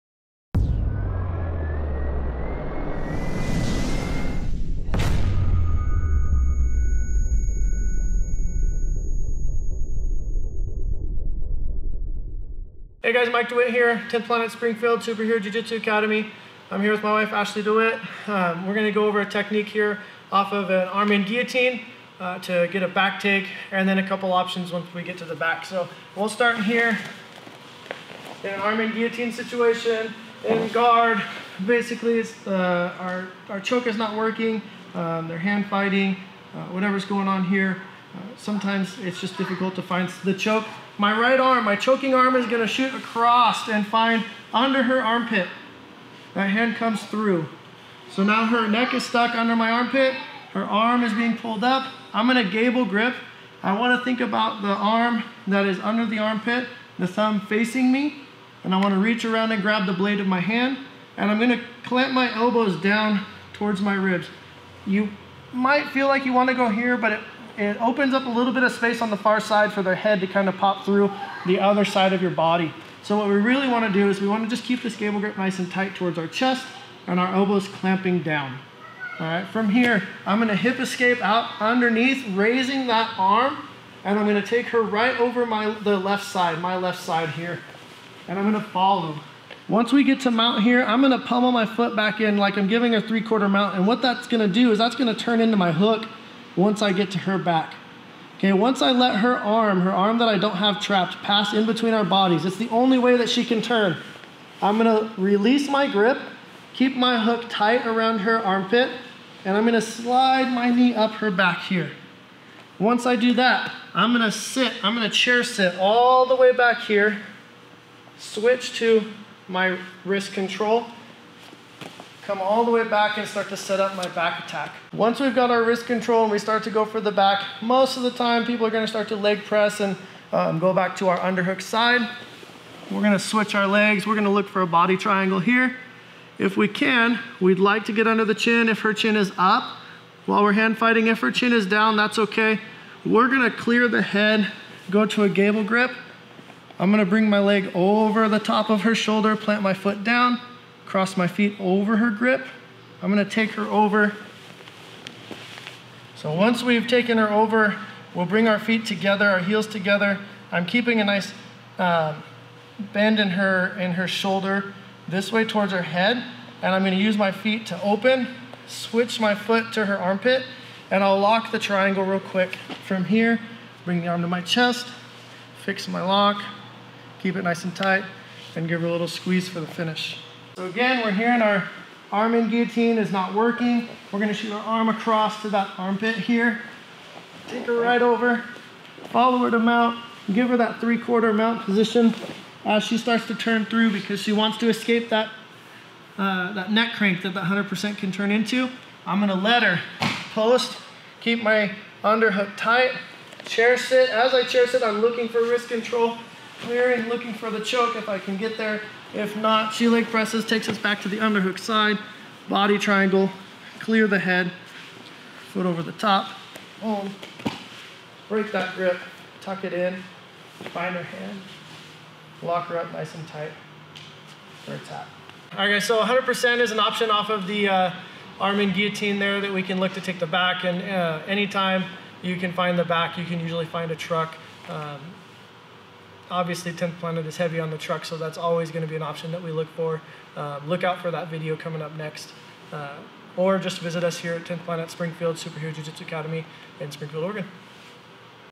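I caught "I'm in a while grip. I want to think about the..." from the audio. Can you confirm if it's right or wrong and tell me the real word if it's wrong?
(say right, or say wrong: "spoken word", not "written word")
wrong: "gable", not "while".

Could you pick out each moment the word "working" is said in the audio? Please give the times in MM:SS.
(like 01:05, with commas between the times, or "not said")
00:34, 03:03.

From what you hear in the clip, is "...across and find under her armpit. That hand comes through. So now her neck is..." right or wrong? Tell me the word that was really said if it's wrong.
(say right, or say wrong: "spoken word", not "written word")
right.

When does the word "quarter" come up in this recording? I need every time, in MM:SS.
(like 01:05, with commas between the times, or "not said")
01:33, 03:10.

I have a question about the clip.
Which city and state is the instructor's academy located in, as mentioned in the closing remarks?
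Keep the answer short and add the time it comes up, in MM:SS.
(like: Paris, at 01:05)
Springfield, Oregon, at 04:06.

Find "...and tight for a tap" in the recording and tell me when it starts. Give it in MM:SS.
03:43.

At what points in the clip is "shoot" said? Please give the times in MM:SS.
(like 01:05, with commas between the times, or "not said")
00:42, 03:04.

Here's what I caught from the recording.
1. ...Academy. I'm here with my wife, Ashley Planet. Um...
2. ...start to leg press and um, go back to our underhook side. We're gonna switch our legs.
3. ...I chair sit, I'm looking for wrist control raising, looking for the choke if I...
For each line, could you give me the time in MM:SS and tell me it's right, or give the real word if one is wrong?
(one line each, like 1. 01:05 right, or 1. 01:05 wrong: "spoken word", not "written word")
1. 00:15 wrong: "DeWitt", not "Planet"
2. 02:08 right
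3. 03:24 wrong: "clearing", not "raising".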